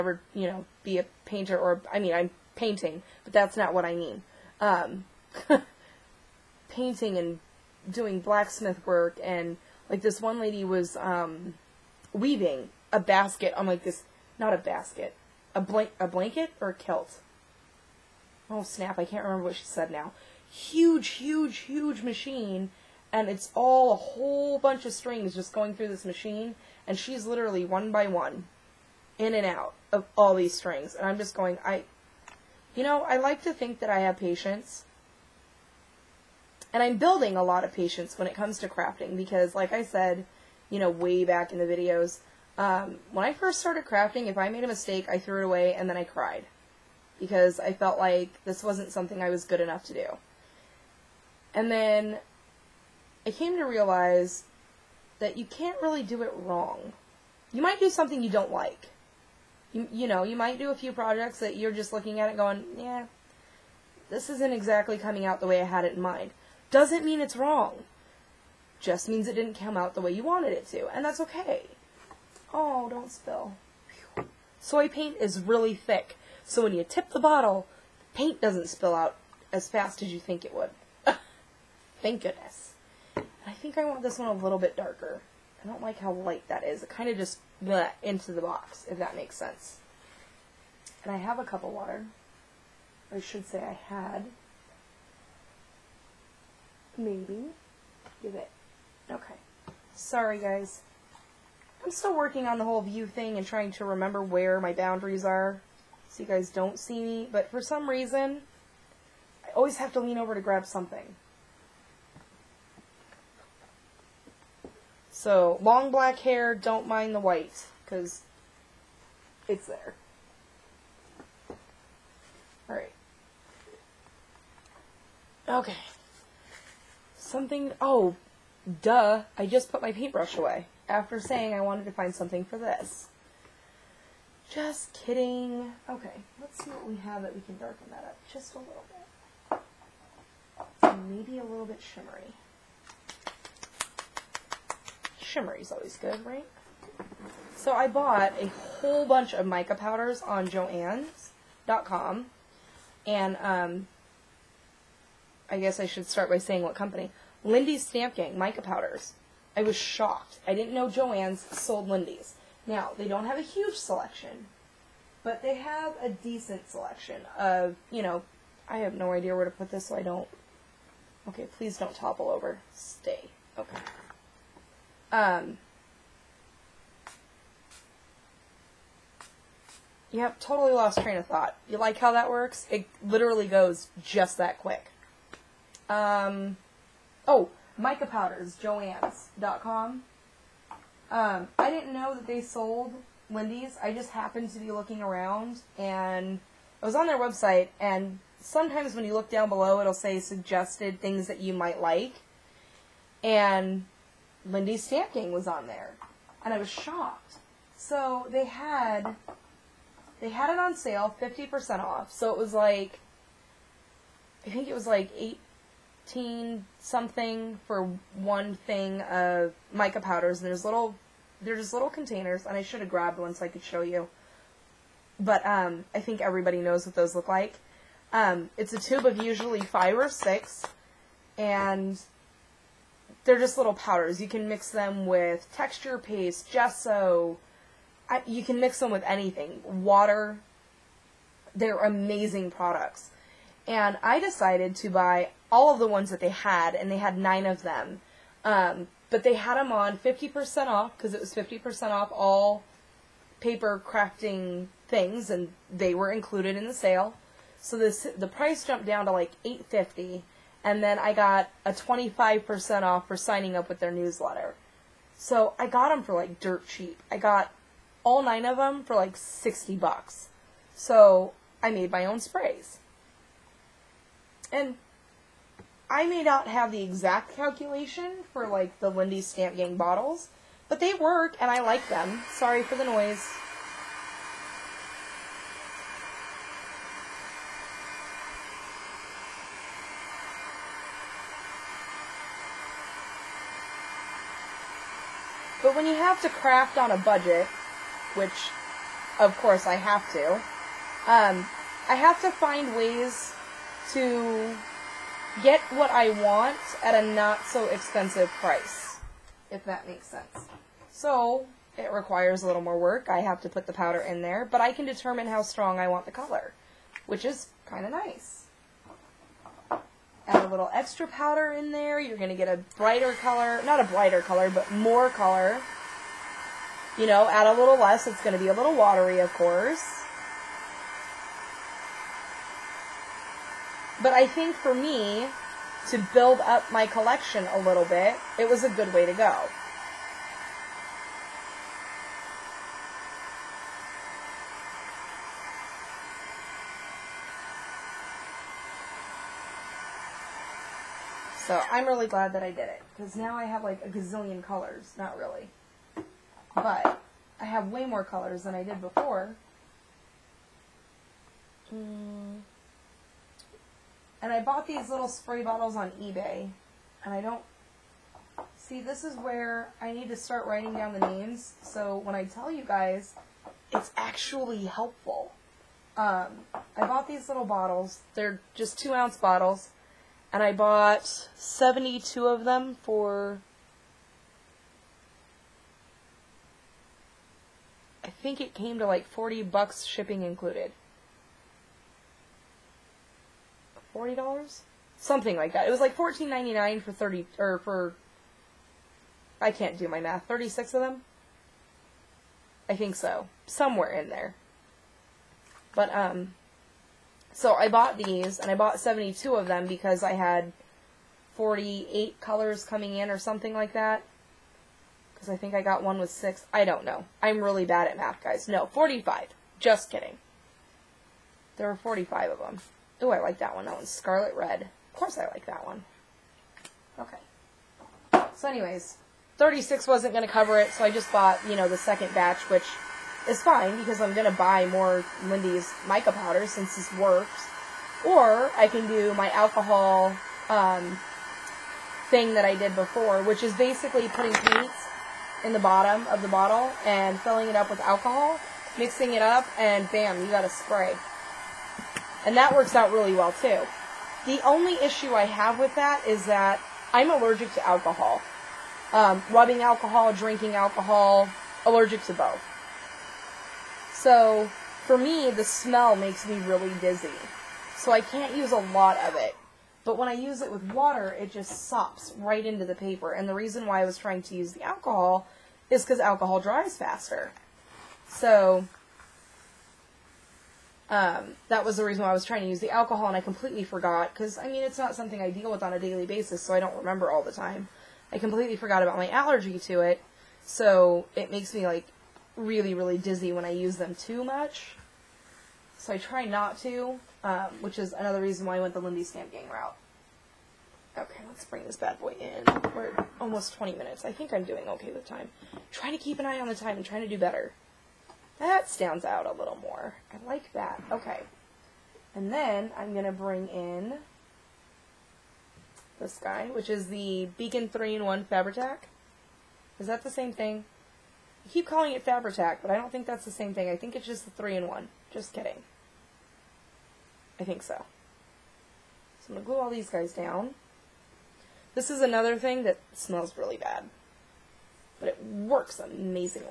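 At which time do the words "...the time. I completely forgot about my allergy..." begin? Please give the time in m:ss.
8:07.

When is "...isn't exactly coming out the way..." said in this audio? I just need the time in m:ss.
1:04.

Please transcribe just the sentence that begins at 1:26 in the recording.
It kind of just bleh, into the box, if that makes sense.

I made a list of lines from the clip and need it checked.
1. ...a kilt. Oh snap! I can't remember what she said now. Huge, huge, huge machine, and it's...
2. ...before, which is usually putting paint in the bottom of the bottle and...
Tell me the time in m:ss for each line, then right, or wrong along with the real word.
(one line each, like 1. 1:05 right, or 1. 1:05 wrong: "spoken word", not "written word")
1. 0:16 right
2. 7:22 wrong: "basically", not "usually".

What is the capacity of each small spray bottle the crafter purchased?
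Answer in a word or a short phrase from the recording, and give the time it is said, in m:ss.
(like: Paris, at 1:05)
2 ounces, at 6:18.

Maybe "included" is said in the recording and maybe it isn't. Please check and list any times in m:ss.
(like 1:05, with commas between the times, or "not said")
4:16, 6:30.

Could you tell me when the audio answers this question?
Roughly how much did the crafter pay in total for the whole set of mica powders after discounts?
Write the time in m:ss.
4:29.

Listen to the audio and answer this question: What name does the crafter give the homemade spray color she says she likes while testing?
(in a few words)
Scarlet Red.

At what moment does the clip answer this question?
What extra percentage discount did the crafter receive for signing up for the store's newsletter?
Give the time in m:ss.
4:21.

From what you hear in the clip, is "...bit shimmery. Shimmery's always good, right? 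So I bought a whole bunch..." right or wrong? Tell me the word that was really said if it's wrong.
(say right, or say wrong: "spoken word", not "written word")
right.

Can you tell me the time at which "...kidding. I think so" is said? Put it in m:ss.
8:45.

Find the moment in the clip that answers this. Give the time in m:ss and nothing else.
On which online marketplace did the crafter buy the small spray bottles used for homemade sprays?
6:06.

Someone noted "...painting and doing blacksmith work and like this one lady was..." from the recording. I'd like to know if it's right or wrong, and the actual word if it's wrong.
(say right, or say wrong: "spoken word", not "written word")
right.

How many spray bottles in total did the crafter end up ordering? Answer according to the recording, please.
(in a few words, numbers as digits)
72.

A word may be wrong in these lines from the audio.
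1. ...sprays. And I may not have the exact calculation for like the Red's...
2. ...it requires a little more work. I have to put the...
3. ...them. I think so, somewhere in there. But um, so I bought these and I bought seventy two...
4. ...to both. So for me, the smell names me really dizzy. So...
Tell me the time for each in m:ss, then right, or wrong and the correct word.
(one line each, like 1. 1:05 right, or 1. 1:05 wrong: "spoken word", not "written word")
1. 4:32 wrong: "Lindy", not "Red"
2. 5:11 right
3. 6:40 right
4. 7:42 wrong: "makes", not "names".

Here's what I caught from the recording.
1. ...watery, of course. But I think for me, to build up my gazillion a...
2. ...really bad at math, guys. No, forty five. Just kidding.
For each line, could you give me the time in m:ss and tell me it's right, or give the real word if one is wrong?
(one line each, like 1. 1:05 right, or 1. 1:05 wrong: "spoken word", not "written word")
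1. 5:28 wrong: "collection", not "gazillion"
2. 6:57 right.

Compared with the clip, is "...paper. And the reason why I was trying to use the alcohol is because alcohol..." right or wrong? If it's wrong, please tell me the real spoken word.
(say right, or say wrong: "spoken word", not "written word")
right.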